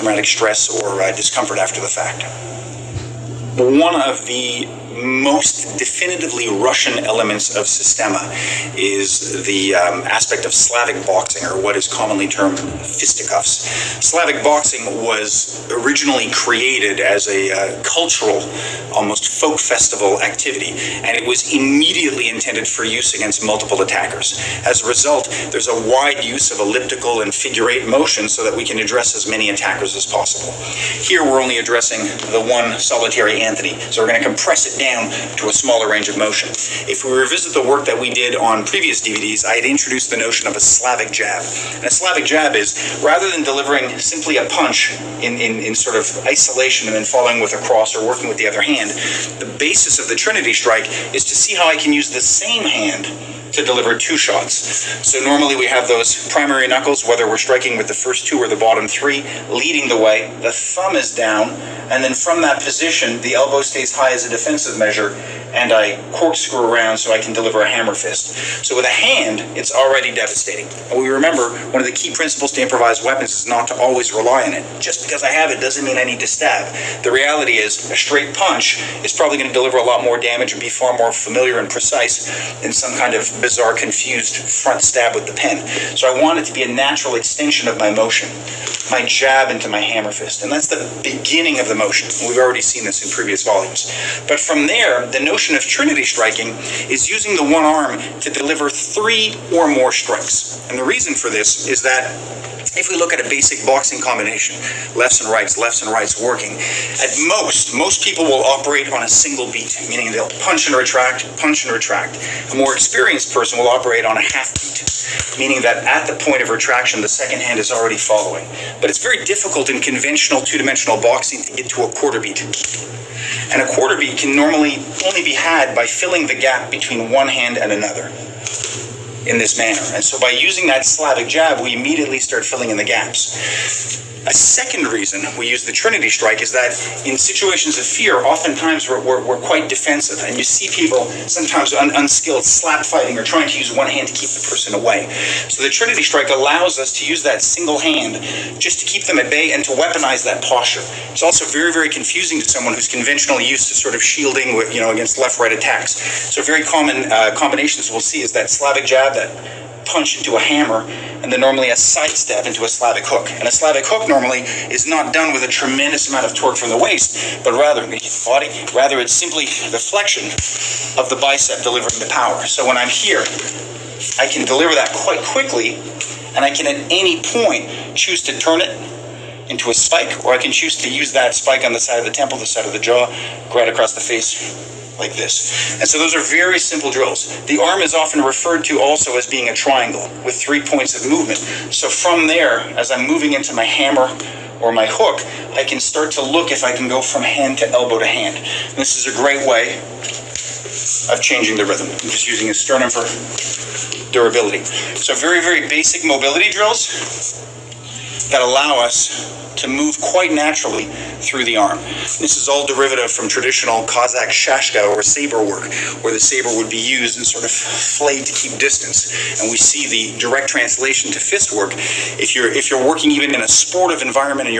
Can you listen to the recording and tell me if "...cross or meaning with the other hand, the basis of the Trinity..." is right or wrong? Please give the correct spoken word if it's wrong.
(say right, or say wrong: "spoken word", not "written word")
wrong: "working", not "meaning".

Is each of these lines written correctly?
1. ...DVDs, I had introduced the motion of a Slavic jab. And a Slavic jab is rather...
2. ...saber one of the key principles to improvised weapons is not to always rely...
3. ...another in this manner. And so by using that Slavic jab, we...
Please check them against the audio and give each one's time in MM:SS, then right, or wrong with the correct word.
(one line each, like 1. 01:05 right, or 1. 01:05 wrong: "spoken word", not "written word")
1. 00:39 wrong: "notion", not "motion"
2. 01:11 wrong: "remember", not "saber"
3. 02:07 right.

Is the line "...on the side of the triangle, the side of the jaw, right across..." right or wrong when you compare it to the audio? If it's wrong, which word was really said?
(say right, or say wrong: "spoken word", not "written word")
wrong: "temple", not "triangle".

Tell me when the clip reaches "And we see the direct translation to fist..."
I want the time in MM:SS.
03:39.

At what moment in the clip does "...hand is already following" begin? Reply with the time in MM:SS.
01:57.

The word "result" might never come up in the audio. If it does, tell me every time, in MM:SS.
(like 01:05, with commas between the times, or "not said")
00:24.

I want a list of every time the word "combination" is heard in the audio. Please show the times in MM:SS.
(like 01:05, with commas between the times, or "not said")
01:44, 02:37.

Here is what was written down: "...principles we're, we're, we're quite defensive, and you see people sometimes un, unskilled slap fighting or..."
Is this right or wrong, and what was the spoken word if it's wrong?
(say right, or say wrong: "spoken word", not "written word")
wrong: "oftentimes", not "principles".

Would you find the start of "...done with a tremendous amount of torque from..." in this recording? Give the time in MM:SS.
02:45.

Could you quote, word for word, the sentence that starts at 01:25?
So I want it to be a natural extension of my motion, my jab into my hammer fist.